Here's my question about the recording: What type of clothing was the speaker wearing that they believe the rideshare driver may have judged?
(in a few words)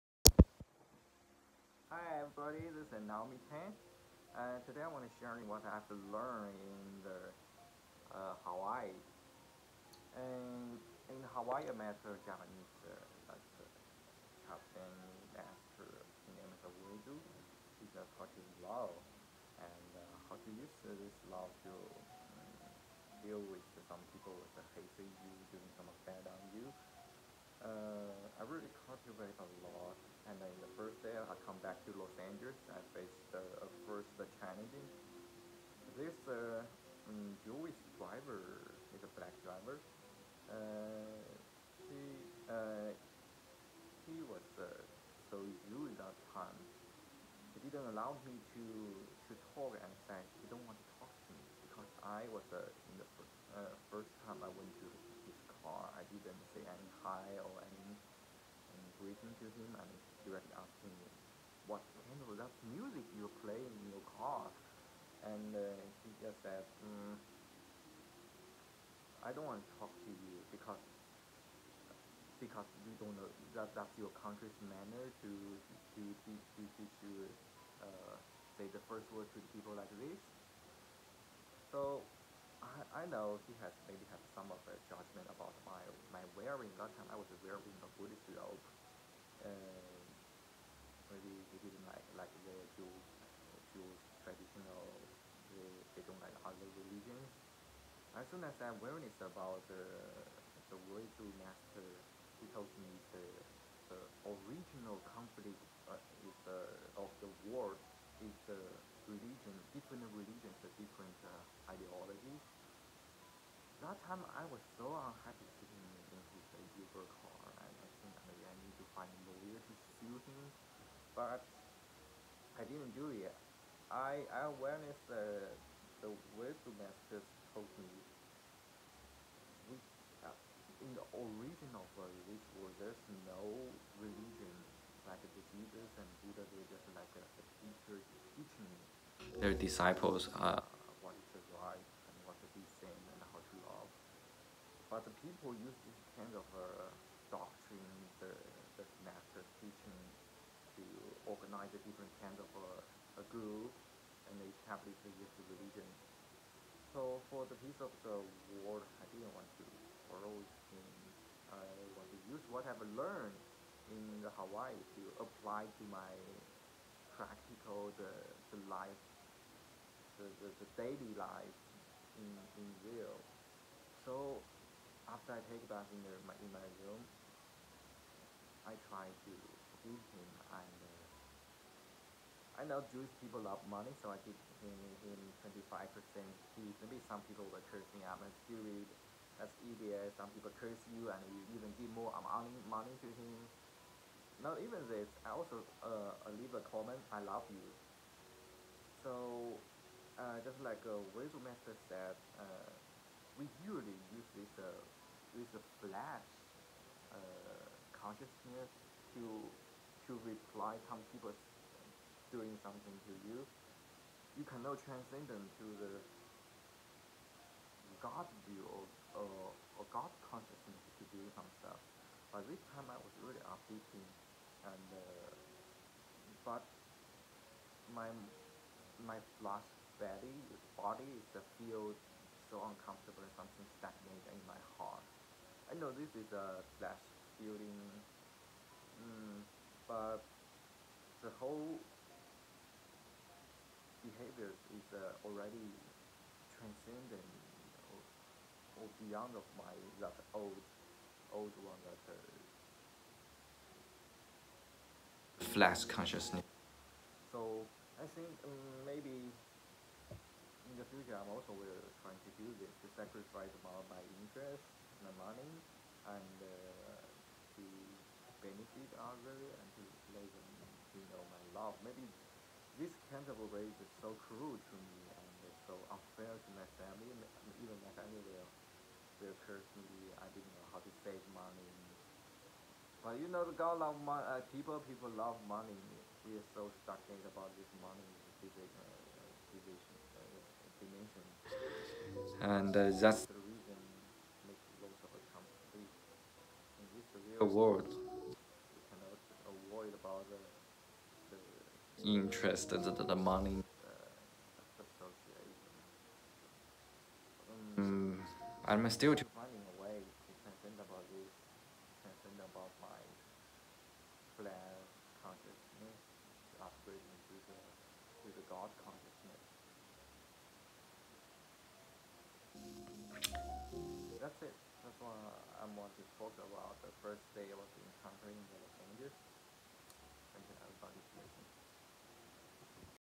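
Buddhist robe.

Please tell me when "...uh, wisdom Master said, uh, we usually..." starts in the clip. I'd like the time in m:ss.
3:20.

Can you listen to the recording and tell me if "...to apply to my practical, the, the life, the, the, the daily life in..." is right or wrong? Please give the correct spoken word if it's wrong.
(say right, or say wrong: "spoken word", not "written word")
right.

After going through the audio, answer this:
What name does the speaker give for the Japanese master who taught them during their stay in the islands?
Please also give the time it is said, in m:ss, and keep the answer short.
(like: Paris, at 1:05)
Uedu, at 0:16.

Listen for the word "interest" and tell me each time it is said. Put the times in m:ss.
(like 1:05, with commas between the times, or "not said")
4:24, 5:02.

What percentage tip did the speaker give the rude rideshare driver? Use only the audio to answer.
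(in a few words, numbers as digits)
25%.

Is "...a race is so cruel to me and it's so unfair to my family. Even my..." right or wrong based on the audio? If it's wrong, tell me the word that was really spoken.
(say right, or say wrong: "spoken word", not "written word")
right.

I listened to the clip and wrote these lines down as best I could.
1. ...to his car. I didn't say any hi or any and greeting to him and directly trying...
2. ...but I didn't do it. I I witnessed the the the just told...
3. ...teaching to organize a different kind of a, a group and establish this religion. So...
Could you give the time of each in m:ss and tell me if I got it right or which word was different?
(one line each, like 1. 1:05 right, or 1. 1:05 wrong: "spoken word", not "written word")
1. 0:54 wrong: "asking", not "trying"
2. 2:01 right
3. 2:29 right.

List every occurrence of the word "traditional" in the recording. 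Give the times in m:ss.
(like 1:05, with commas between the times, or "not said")
1:34.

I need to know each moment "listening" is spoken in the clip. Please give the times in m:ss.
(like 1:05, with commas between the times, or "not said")
5:31.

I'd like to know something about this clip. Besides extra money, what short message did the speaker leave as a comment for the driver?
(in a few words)
I love you.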